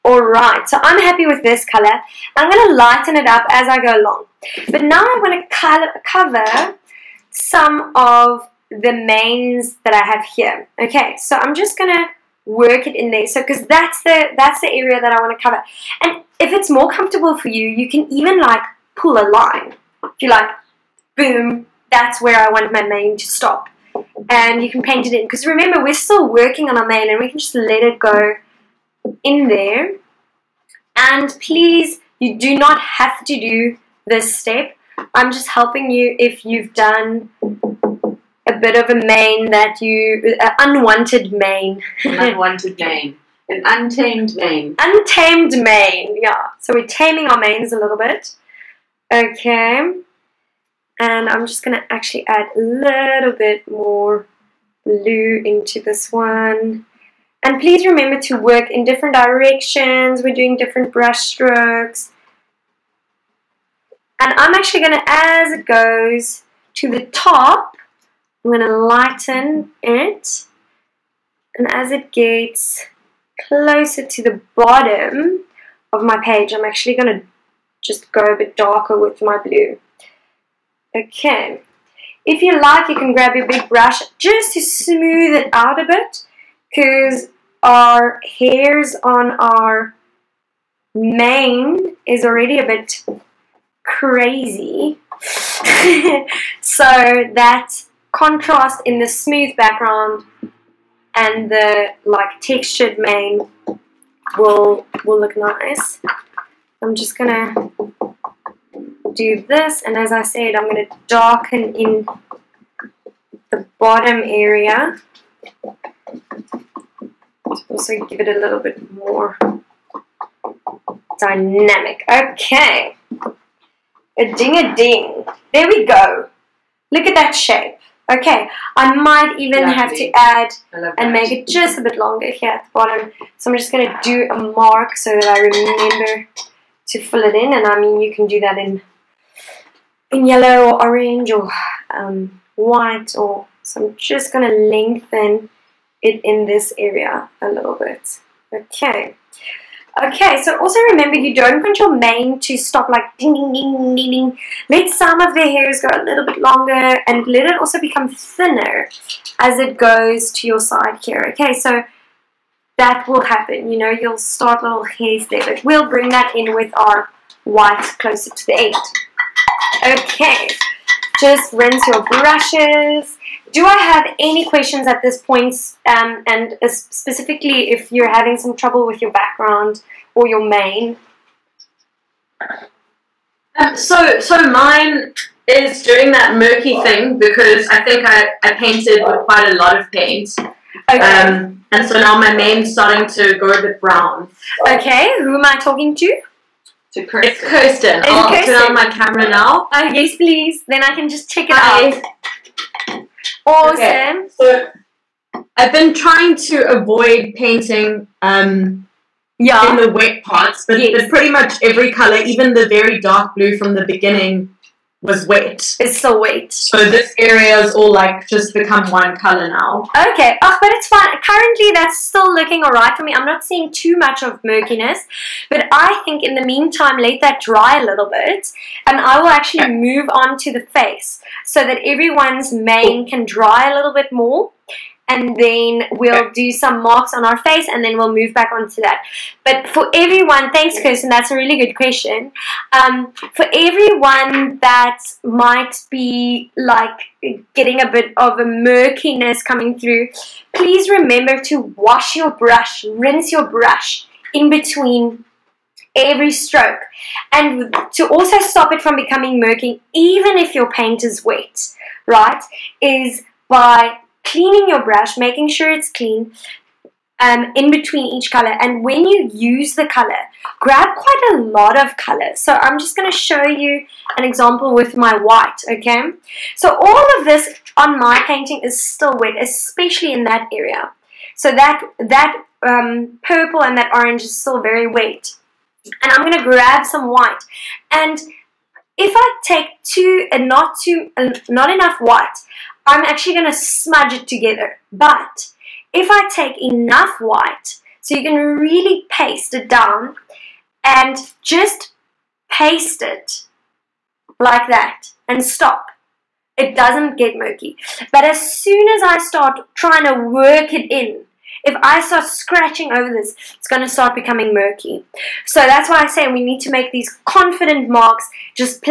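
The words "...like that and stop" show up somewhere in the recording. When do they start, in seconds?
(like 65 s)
304 s.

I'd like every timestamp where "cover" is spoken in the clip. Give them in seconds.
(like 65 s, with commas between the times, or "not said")
6 s, 15 s.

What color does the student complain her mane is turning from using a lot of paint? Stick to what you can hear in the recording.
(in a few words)
brown.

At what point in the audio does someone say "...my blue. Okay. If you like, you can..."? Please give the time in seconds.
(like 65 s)
79 s.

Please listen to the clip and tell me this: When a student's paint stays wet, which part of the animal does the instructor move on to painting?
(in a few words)
the face.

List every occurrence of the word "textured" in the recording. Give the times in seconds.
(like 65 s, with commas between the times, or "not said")
102 s.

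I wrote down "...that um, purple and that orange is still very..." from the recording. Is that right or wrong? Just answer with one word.
right.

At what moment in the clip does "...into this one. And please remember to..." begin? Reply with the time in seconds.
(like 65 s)
55 s.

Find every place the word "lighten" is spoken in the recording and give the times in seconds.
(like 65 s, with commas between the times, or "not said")
2 s, 68 s.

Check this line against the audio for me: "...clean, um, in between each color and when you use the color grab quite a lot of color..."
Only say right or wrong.
right.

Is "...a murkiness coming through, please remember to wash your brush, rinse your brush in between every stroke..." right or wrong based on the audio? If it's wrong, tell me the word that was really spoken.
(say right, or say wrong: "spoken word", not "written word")
right.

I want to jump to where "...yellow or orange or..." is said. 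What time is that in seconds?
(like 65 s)
140 s.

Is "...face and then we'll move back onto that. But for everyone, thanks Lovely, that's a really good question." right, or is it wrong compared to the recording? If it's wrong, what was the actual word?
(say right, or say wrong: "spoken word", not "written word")
wrong: "Kirsten", not "Lovely".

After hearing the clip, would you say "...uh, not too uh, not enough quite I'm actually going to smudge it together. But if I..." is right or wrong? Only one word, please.
wrong.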